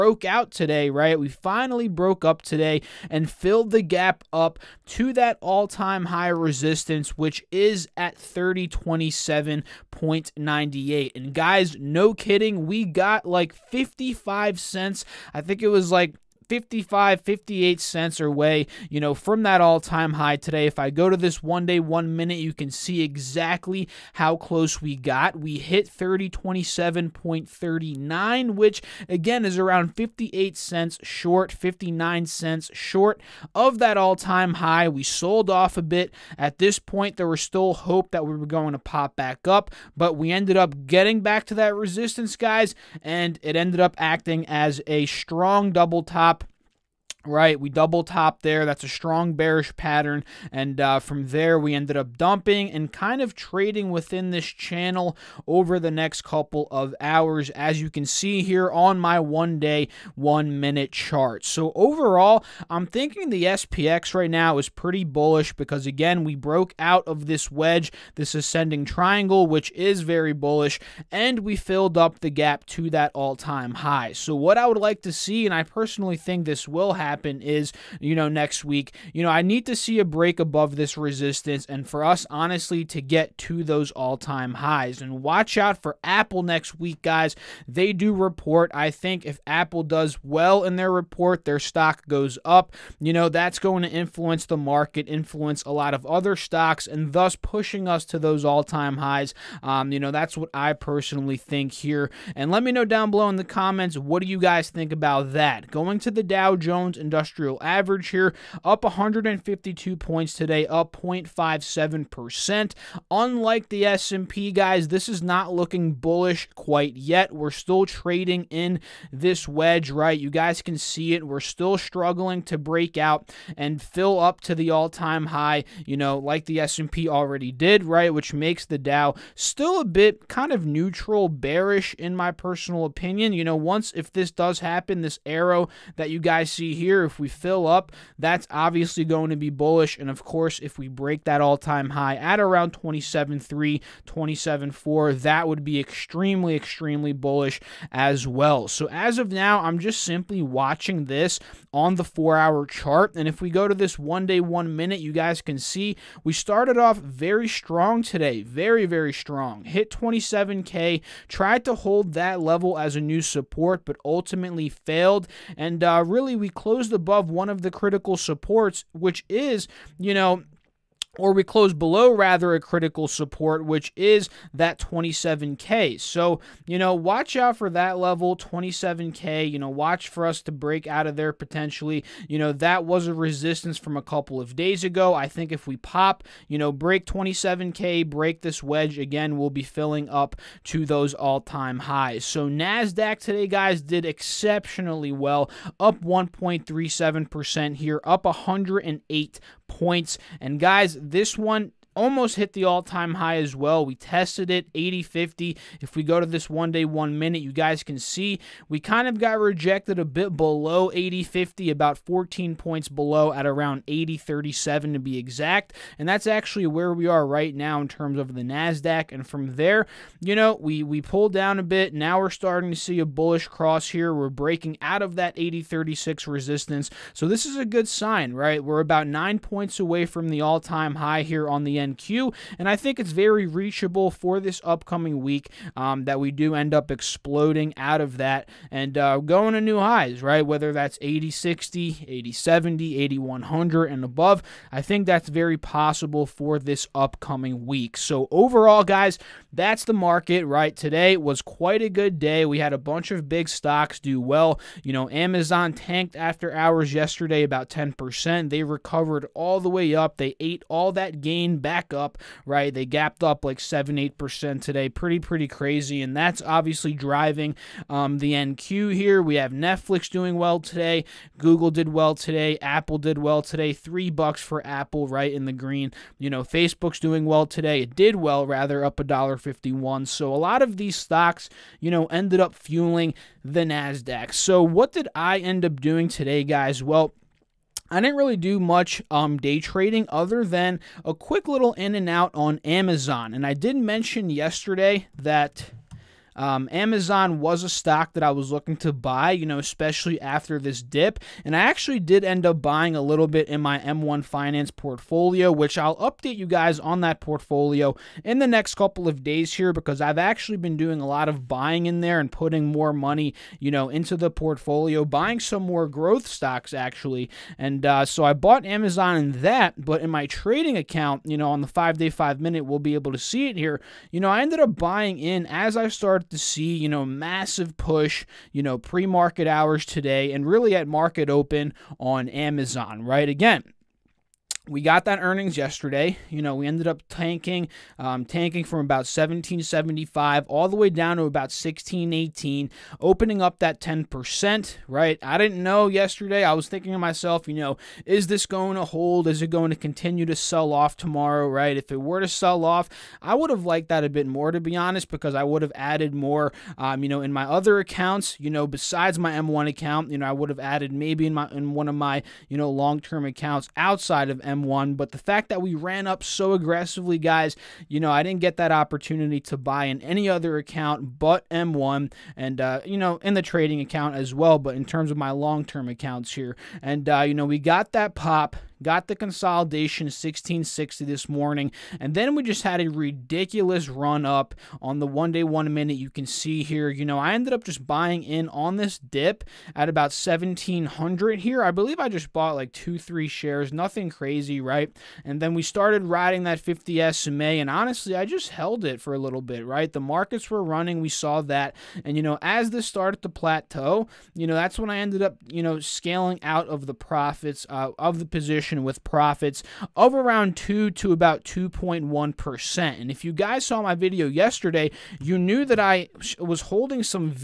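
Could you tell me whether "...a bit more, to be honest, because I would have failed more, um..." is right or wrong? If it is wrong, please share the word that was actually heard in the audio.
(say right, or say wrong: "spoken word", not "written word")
wrong: "added", not "failed".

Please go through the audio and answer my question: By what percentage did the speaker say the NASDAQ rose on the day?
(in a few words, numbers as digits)
1.37%.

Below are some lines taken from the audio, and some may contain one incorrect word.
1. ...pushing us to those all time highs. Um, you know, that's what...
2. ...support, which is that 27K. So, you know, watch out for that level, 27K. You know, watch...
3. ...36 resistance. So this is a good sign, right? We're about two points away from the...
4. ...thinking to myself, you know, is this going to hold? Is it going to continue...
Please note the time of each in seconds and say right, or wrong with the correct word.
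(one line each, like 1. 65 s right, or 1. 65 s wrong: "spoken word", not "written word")
1. 97 s right
2. 173 s right
3. 225 s wrong: "nine", not "two"
4. 346 s right.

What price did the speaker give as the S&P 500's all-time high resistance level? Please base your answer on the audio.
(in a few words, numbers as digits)
3027.98.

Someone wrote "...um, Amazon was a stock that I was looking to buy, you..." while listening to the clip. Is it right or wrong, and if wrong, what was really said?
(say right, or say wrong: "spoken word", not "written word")
right.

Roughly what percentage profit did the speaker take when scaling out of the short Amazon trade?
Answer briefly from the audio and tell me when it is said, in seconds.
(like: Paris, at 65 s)
about 2 to 2.1%, at 410 s.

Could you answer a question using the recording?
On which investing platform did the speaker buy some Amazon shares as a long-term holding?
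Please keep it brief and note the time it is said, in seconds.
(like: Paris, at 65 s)
M1 Finance, at 303 s.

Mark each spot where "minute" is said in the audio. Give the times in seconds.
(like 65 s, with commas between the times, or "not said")
22 s, 60 s, 154 s, 207 s, 322 s, 385 s.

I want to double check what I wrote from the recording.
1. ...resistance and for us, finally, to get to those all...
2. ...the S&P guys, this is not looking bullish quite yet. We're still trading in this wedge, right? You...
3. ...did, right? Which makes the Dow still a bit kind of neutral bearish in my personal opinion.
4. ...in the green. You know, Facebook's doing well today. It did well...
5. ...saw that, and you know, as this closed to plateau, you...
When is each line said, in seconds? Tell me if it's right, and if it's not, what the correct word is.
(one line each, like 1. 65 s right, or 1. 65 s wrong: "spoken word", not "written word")
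1. 80 s wrong: "honestly", not "finally"
2. 113 s right
3. 127 s right
4. 275 s right
5. 401 s wrong: "started", not "closed".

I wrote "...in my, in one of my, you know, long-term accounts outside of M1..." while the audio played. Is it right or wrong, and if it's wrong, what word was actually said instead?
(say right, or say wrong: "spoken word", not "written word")
right.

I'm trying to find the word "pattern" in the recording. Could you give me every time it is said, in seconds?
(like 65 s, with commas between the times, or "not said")
49 s.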